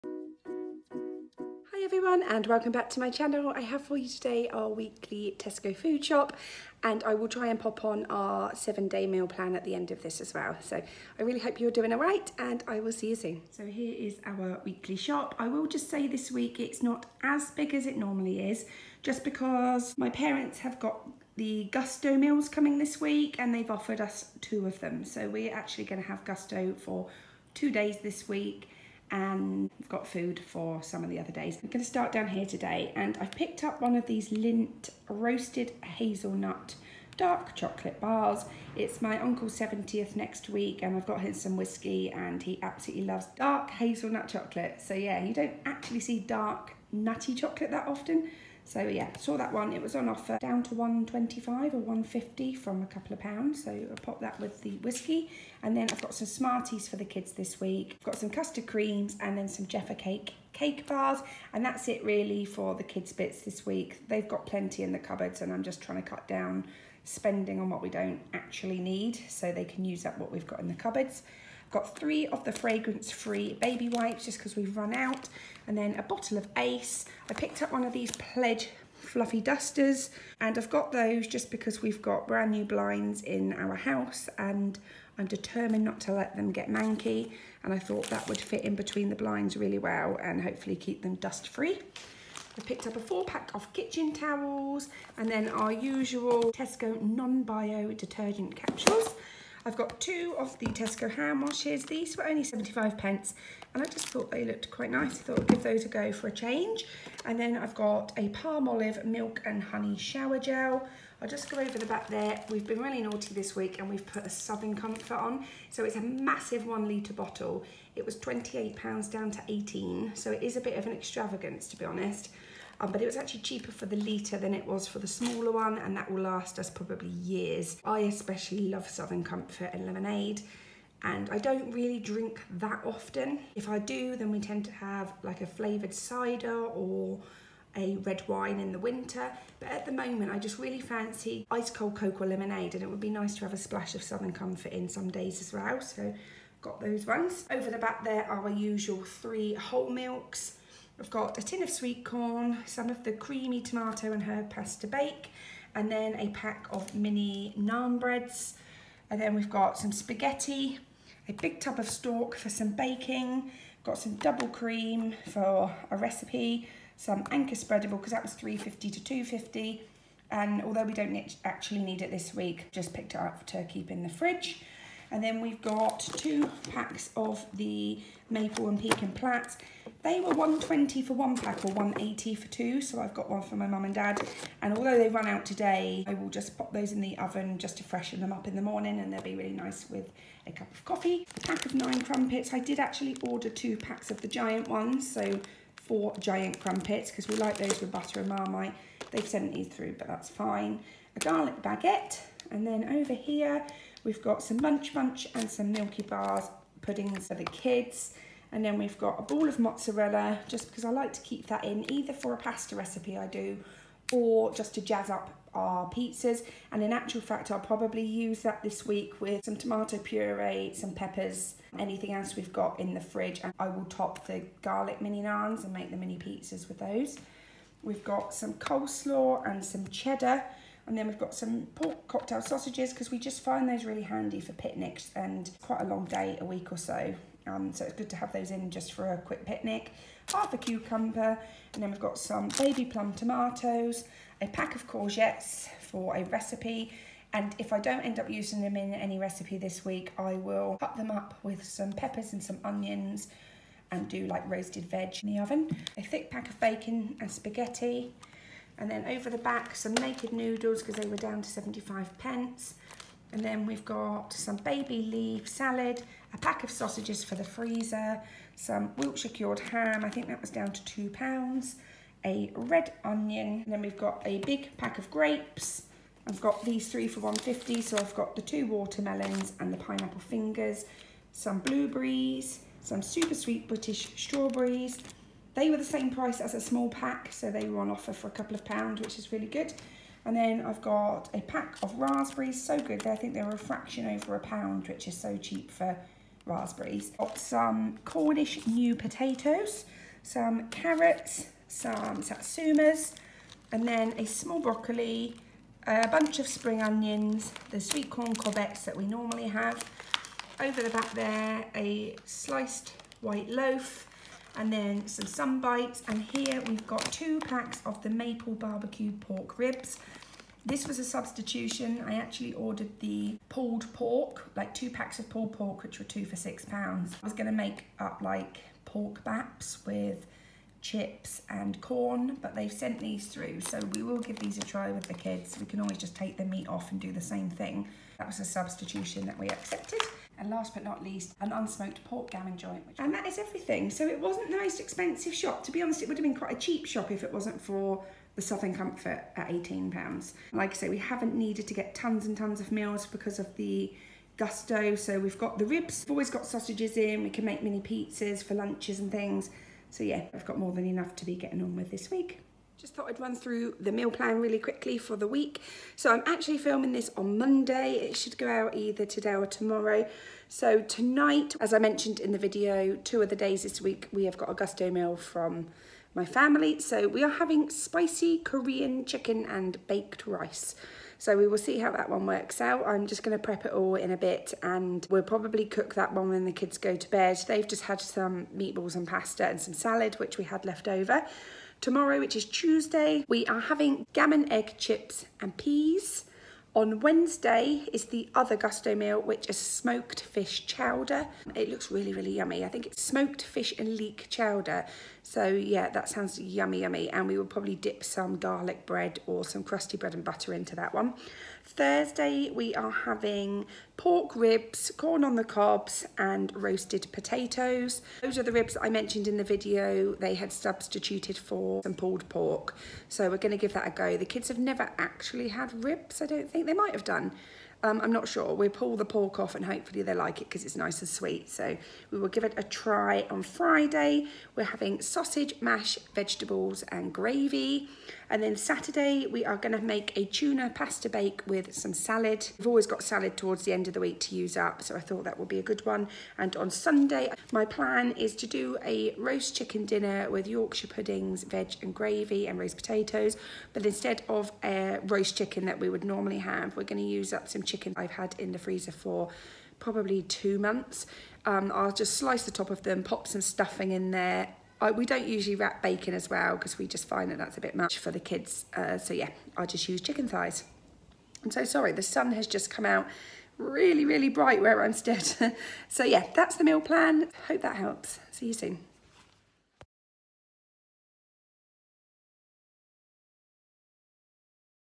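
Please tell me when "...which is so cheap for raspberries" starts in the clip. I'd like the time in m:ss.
4:54.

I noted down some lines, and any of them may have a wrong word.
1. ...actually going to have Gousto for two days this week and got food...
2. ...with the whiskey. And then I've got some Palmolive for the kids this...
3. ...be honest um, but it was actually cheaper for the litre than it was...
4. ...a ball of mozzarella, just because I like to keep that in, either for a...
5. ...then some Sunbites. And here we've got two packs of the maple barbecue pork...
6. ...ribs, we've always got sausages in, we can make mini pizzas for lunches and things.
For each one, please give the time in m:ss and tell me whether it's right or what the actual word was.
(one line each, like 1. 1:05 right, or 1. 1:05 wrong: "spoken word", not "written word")
1. 0:25 right
2. 0:54 wrong: "Smarties", not "Palmolive"
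3. 2:01 right
4. 3:29 right
5. 5:14 right
6. 5:55 right.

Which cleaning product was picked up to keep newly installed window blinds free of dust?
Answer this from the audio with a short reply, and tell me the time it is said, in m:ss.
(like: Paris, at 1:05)
Pledge fluffy dusters, at 1:18.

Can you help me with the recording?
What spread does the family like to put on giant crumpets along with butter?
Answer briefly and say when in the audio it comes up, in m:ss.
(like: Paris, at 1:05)
Marmite, at 3:18.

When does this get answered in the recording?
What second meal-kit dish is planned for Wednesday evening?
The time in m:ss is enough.
6:39.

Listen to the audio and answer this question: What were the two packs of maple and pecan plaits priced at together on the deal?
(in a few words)
180.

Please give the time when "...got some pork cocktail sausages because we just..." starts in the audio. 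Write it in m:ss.
3:51.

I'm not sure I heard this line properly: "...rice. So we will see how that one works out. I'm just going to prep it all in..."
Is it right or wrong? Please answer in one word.
right.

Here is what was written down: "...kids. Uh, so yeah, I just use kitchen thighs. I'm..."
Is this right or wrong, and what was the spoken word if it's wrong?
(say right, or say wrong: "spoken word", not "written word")
wrong: "chicken", not "kitchen".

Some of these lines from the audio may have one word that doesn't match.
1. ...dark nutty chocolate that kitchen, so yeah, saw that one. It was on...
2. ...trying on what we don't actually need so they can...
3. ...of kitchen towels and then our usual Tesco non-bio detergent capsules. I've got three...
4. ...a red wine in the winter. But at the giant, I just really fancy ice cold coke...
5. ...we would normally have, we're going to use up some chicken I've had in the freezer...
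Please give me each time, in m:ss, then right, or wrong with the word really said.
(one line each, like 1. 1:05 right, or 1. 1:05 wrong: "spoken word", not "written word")
1. 0:46 wrong: "often", not "kitchen"
2. 1:07 wrong: "spending", not "trying"
3. 1:33 wrong: "two", not "three"
4. 2:17 wrong: "moment", not "giant"
5. 7:35 right.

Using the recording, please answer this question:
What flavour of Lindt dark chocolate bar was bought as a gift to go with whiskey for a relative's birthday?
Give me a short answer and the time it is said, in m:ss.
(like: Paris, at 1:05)
Roasted Hazelnut, at 0:35.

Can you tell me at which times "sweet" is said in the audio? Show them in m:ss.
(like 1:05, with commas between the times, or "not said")
2:31, 4:43, 5:07, 7:11.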